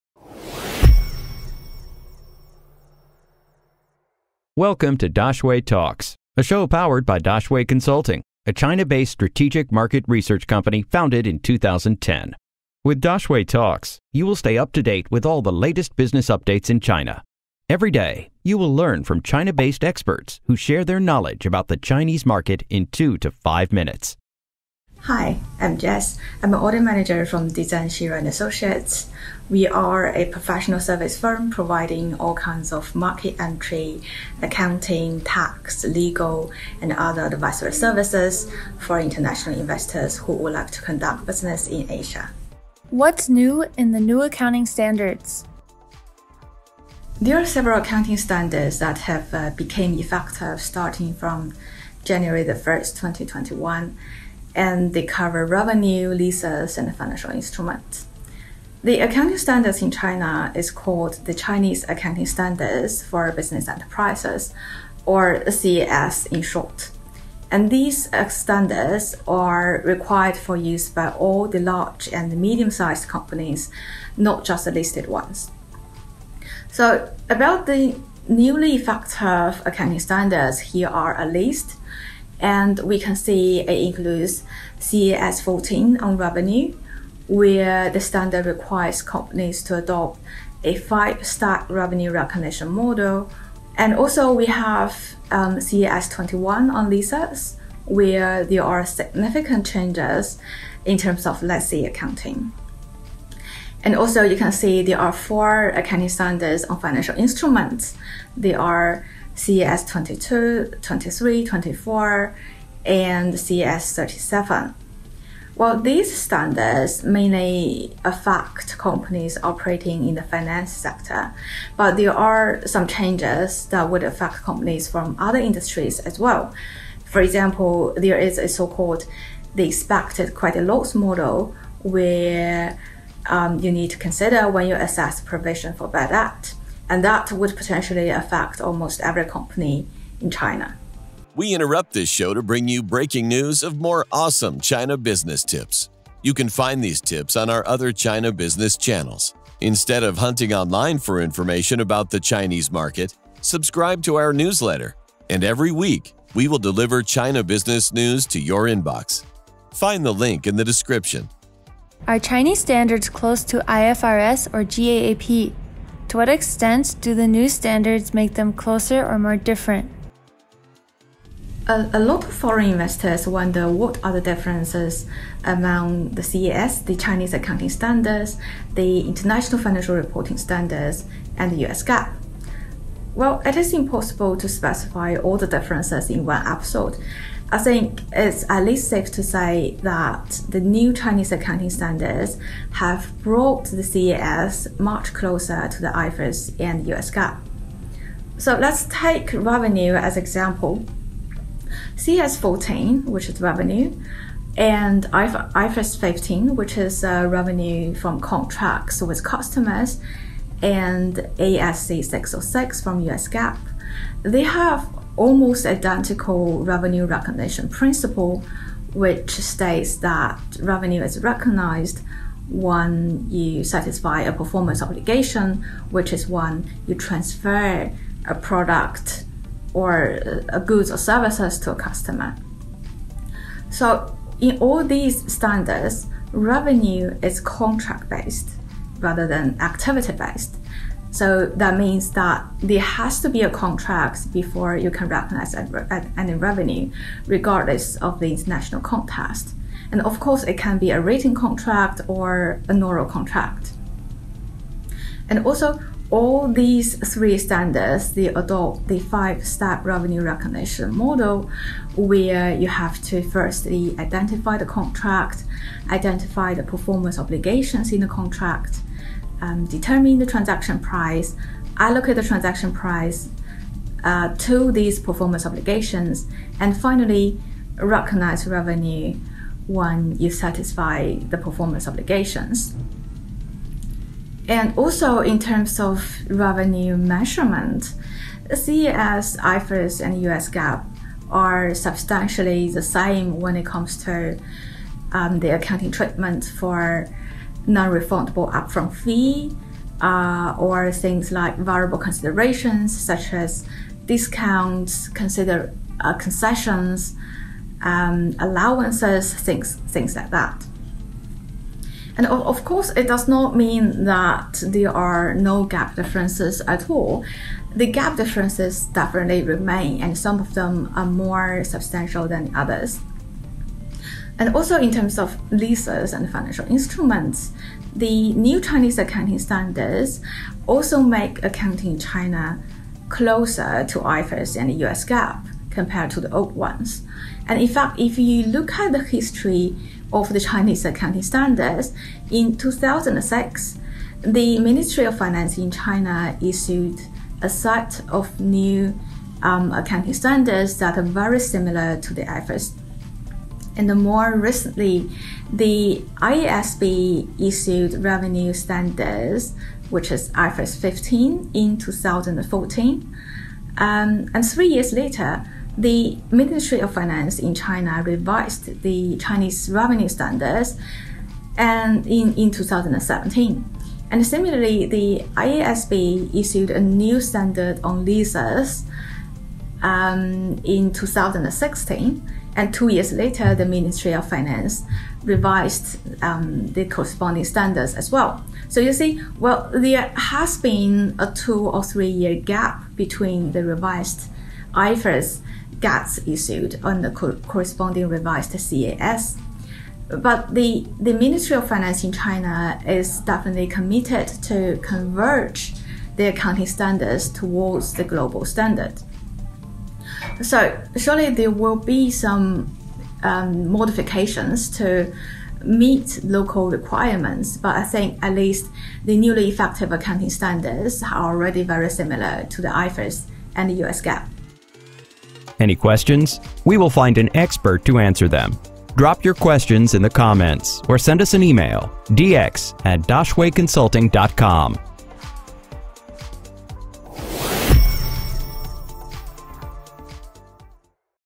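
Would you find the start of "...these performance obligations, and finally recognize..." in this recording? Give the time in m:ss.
4:34.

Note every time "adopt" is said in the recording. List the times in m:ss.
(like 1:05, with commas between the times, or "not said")
1:29, 4:18.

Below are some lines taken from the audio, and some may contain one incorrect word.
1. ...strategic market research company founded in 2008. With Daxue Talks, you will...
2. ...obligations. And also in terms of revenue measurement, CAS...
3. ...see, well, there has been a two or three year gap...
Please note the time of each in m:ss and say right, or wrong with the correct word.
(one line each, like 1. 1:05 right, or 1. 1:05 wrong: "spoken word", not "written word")
1. 0:09 wrong: "2010", not "2008"
2. 4:41 right
3. 6:28 right.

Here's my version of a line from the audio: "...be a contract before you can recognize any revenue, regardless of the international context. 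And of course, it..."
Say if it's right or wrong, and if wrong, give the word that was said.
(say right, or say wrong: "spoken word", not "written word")
right.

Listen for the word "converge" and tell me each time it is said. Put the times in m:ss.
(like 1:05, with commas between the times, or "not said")
6:44.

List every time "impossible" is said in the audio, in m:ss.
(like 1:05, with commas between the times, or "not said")
3:03.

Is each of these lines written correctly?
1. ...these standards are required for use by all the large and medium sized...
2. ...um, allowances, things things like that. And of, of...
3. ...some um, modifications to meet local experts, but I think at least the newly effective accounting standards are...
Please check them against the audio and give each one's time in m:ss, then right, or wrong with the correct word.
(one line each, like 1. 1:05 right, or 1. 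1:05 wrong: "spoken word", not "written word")
1. 1:07 right
2. 5:07 right
3. 6:52 wrong: "requirements", not "experts".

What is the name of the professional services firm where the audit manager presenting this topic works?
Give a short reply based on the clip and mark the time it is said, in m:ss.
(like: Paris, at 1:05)
Dezan Shira and Associates, at 0:27.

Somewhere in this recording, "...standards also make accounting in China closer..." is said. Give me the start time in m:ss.
5:29.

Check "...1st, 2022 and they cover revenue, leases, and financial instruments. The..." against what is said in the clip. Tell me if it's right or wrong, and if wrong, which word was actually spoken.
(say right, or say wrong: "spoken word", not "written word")
wrong: "2021", not "2022".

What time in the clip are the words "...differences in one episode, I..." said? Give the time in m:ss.
3:05.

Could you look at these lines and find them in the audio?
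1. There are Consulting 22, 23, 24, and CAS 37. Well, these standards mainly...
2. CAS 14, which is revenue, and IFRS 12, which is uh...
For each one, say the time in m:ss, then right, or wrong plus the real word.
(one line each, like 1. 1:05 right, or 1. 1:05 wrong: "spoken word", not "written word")
1. 1:48 wrong: "CAS", not "Consulting"
2. 3:21 wrong: "15", not "12".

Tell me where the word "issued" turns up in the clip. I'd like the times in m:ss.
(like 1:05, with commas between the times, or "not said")
5:46, 5:57, 6:16, 6:36.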